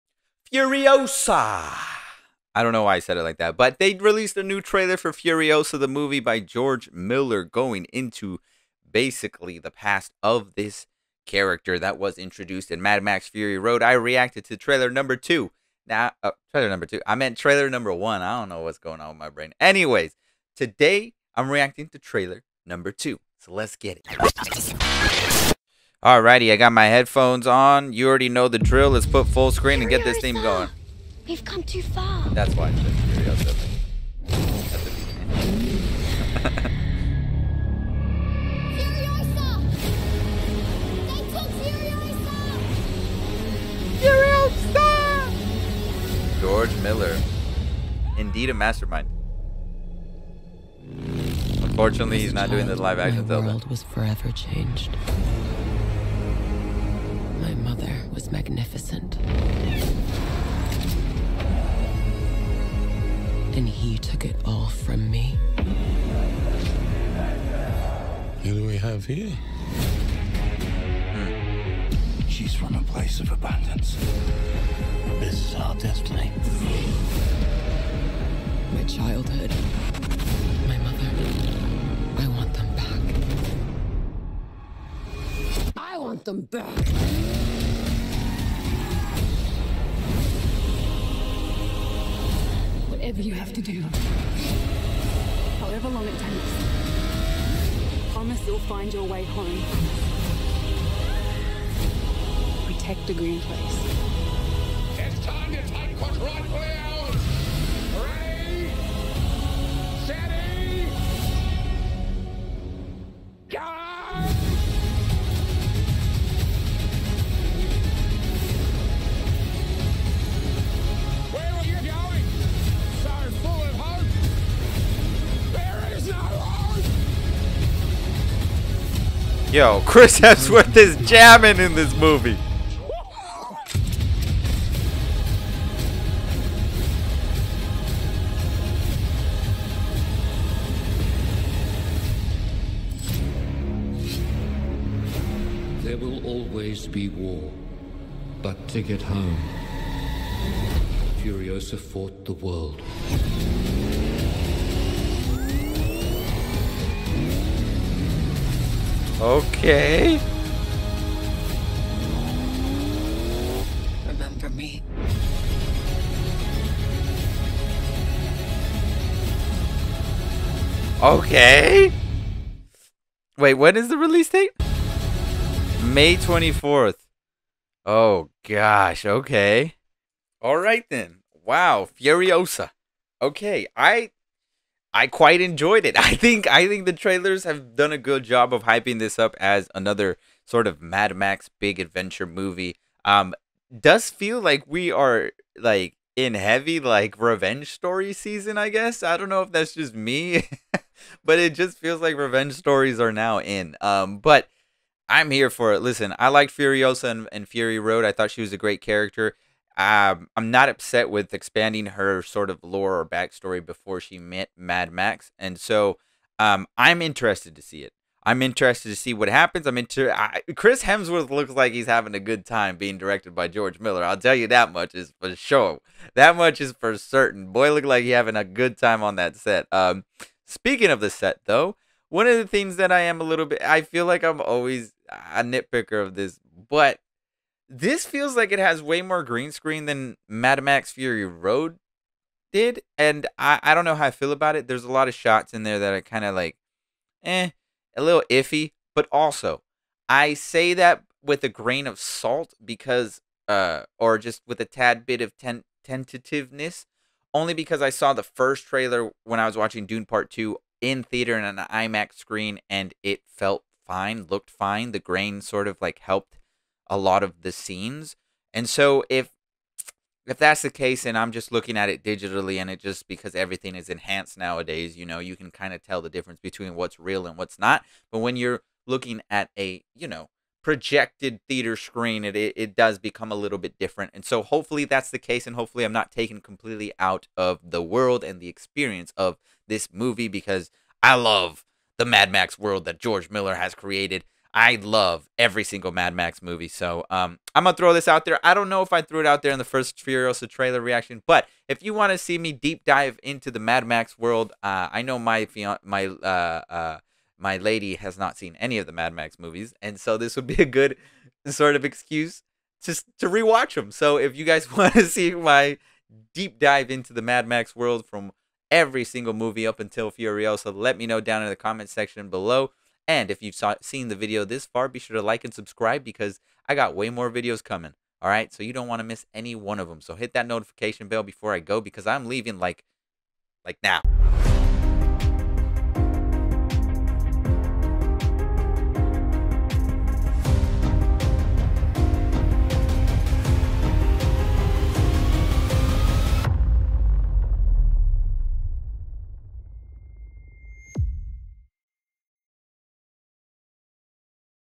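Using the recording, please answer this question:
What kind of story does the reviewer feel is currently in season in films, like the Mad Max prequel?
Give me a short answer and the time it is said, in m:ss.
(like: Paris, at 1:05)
revenge story, at 3:17.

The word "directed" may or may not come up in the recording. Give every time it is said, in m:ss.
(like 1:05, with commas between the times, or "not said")
3:42.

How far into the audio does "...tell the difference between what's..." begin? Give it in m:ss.
4:35.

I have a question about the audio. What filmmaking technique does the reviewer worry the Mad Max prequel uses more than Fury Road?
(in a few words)
green screen.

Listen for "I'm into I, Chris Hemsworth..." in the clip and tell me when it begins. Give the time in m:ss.
3:39.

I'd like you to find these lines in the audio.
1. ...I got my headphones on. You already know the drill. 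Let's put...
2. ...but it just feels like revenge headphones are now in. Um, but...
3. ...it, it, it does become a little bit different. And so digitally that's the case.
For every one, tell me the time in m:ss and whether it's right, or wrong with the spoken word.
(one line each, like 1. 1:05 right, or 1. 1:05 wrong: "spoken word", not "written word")
1. 0:26 right
2. 3:21 wrong: "stories", not "headphones"
3. 4:42 wrong: "hopefully", not "digitally".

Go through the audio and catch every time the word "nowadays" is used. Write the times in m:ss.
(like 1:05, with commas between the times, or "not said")
4:34.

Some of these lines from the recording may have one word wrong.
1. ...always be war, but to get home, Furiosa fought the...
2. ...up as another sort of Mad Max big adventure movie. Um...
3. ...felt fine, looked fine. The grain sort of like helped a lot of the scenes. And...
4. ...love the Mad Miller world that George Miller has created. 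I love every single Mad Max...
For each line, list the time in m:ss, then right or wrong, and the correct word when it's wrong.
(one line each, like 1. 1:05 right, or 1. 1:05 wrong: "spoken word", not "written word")
1. 2:26 right
2. 3:09 right
3. 4:23 right
4. 4:51 wrong: "Max", not "Miller".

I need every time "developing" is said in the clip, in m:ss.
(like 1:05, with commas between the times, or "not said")
not said.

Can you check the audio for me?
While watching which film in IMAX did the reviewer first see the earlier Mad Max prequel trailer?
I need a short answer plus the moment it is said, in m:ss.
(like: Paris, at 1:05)
Dune Part Two, at 4:19.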